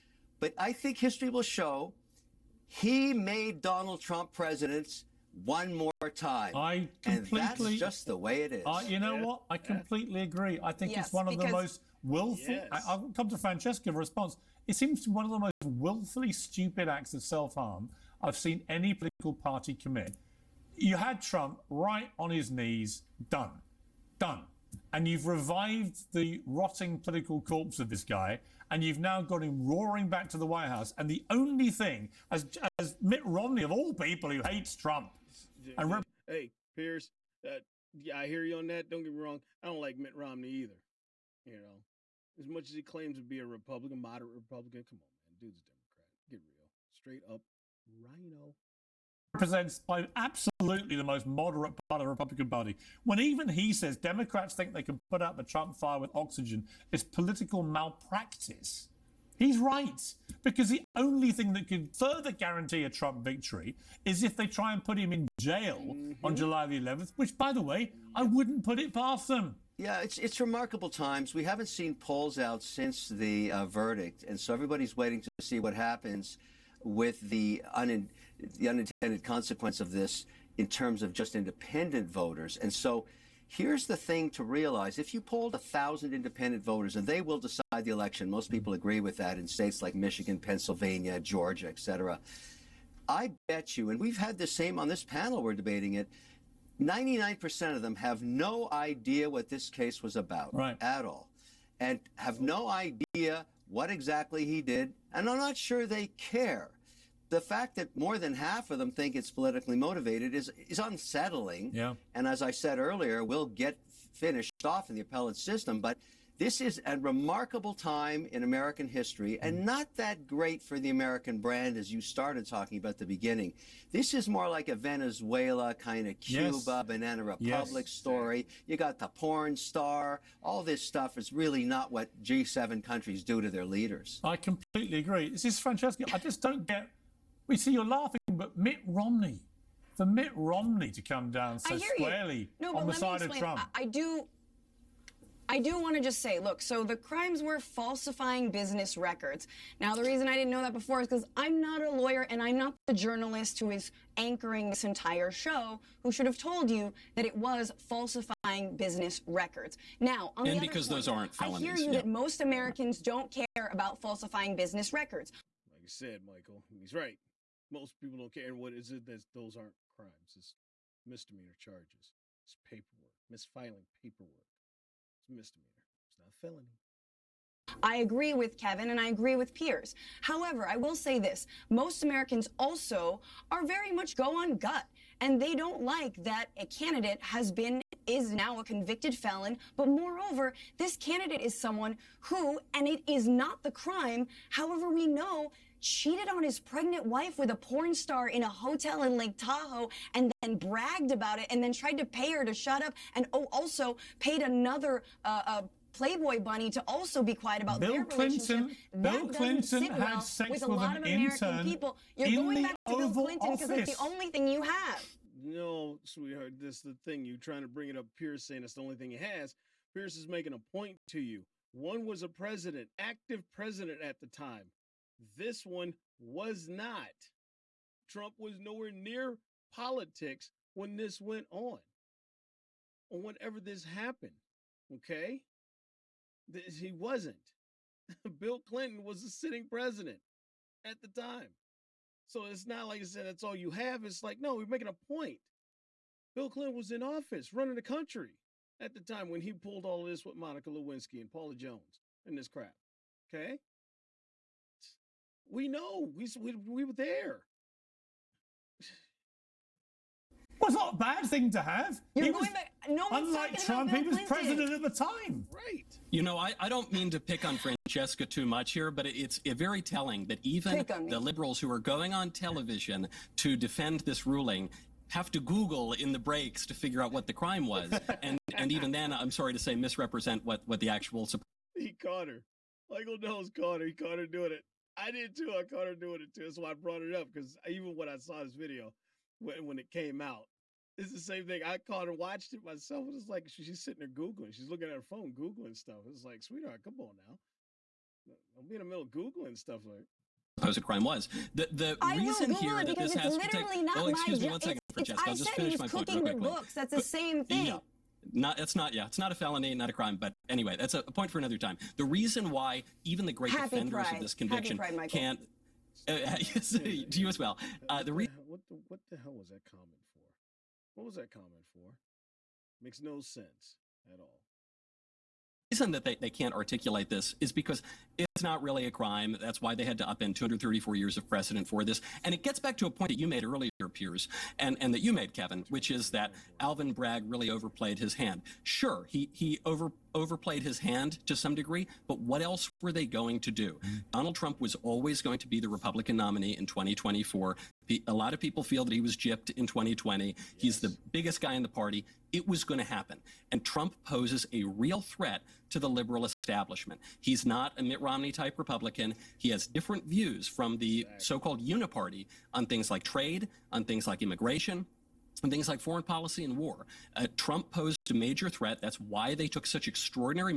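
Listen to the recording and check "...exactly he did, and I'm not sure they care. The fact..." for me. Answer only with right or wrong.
right.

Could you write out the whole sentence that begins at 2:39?
Now, on and the because other point, those aren't felonies.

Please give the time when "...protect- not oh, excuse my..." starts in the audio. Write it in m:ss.
5:03.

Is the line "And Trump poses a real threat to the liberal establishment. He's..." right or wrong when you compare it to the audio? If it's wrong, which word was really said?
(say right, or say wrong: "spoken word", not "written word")
right.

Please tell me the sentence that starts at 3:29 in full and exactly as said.
Bill that Clinton sit well had sex with, with a lot of American people.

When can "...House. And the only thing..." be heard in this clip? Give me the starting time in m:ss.
0:30.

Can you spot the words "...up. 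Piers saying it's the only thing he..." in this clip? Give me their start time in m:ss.
3:37.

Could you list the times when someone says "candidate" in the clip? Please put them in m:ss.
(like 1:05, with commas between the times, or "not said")
3:06, 3:10.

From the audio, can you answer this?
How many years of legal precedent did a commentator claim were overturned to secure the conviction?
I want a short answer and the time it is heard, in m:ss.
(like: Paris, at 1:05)
234, at 5:30.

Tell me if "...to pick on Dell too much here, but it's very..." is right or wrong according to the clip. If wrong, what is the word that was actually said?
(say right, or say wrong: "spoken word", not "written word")
wrong: "Francesca", not "Dell".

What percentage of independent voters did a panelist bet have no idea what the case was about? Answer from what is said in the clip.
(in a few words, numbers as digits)
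99%.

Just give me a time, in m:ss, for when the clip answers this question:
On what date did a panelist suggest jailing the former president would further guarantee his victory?
1:06.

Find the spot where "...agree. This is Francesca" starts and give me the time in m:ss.
2:14.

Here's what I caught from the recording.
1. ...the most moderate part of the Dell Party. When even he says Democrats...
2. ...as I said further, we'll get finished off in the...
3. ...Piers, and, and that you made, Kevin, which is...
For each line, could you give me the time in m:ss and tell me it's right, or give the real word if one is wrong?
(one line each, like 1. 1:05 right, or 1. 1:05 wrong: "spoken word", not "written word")
1. 0:50 wrong: "Republican", not "Dell"
2. 1:52 wrong: "earlier", not "further"
3. 5:33 right.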